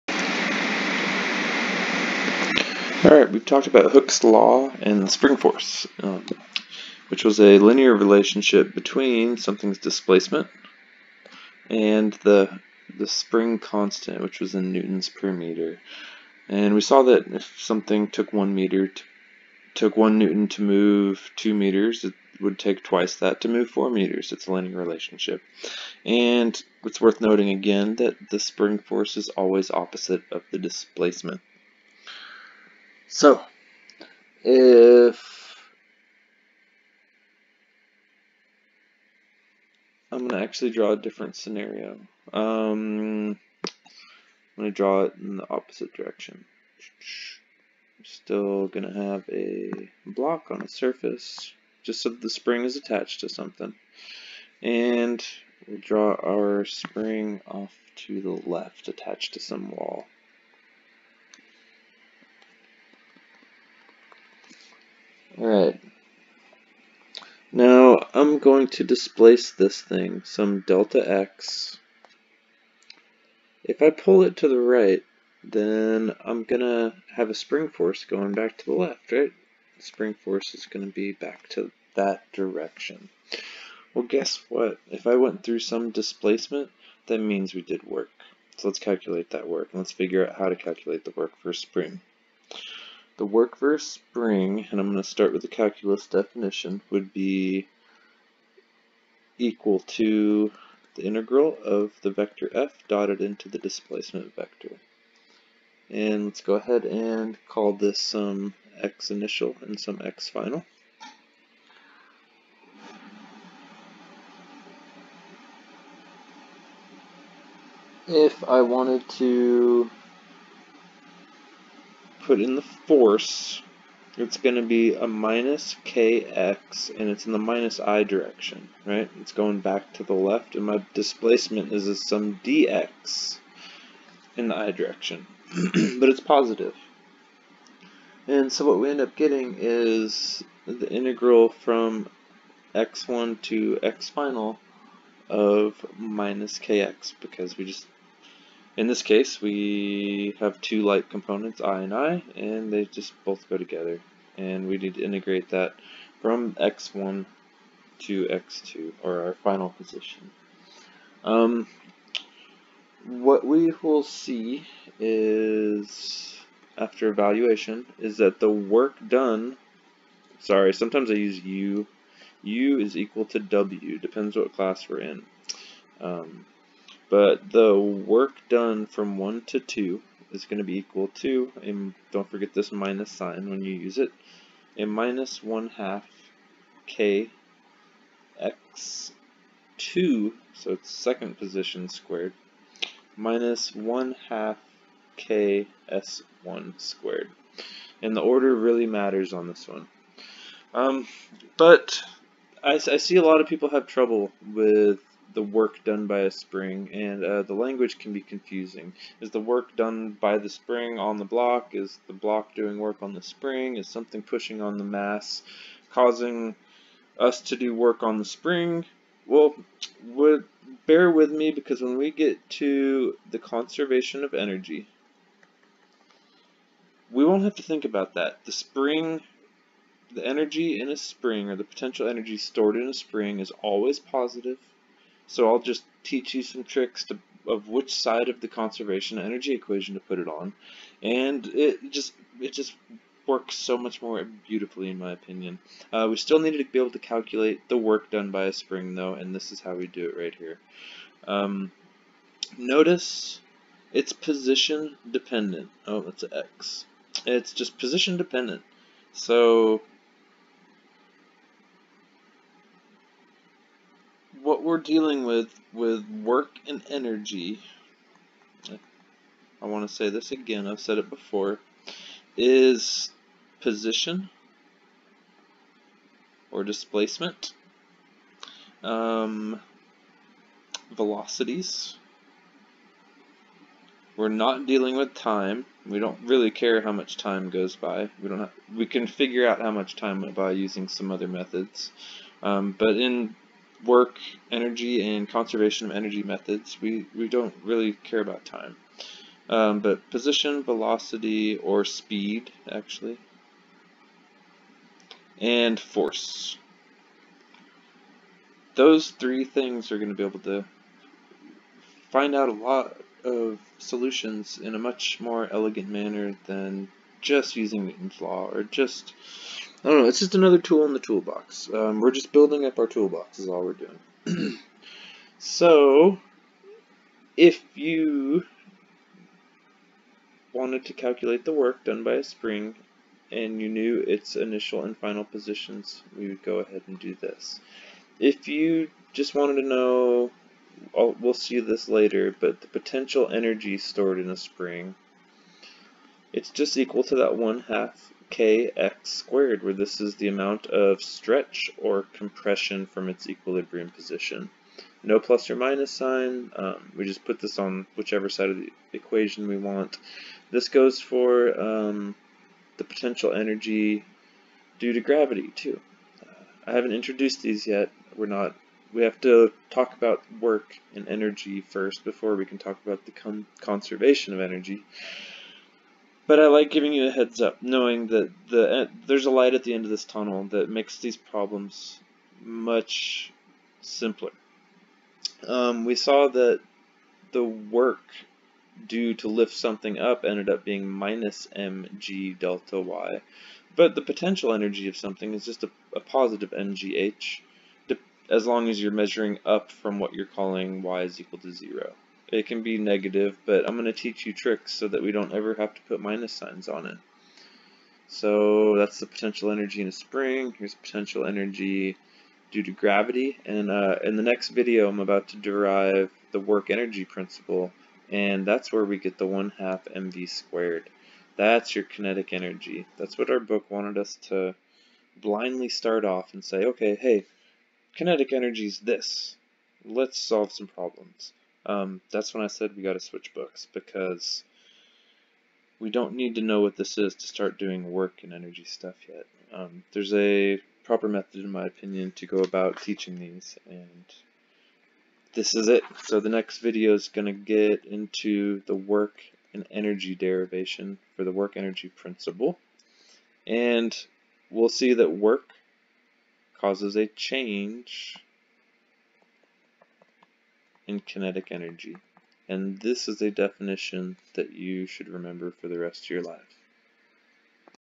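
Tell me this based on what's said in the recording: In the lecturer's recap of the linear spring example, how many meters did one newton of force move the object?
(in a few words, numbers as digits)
2.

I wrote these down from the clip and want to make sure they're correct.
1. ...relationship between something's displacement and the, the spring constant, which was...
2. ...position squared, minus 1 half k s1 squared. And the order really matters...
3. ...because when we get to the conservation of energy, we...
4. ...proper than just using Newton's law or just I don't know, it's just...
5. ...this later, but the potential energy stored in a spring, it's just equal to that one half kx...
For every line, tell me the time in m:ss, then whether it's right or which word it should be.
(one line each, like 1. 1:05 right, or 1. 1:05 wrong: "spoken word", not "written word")
1. 0:07 right
2. 3:11 right
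3. 3:41 right
4. 5:15 wrong: "manner", not "proper"
5. 5:41 right.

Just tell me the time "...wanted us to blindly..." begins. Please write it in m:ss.
7:03.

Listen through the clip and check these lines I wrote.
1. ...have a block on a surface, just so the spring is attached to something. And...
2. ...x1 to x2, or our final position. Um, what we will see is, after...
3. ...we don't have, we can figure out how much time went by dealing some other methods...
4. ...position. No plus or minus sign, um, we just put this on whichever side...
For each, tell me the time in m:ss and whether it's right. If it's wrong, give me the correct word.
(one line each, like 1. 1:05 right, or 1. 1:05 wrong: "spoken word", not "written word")
1. 0:49 right
2. 2:36 right
3. 4:48 wrong: "using", not "dealing"
4. 5:53 right.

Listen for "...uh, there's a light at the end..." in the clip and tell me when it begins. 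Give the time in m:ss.
6:18.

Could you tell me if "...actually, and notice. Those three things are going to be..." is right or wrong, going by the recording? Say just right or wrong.
wrong.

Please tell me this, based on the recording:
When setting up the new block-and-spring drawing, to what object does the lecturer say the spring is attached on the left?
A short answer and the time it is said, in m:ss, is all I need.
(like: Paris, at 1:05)
some wall, at 0:59.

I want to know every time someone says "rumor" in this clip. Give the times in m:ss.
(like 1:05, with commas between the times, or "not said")
not said.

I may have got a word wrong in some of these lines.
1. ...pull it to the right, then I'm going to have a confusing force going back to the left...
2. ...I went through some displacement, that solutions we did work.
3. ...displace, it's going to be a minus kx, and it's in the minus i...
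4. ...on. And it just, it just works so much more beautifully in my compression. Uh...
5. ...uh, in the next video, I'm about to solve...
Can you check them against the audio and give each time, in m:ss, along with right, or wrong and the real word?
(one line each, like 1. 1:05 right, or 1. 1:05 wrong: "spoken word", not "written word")
1. 1:13 wrong: "spring", not "confusing"
2. 1:25 wrong: "means", not "solutions"
3. 2:02 wrong: "force", not "displace"
4. 4:00 wrong: "opinion", not "compression"
5. 6:53 wrong: "derive", not "solve".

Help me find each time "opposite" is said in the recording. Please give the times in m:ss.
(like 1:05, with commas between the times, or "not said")
0:29, 0:45.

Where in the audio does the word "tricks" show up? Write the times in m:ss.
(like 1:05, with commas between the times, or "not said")
3:56, 6:44.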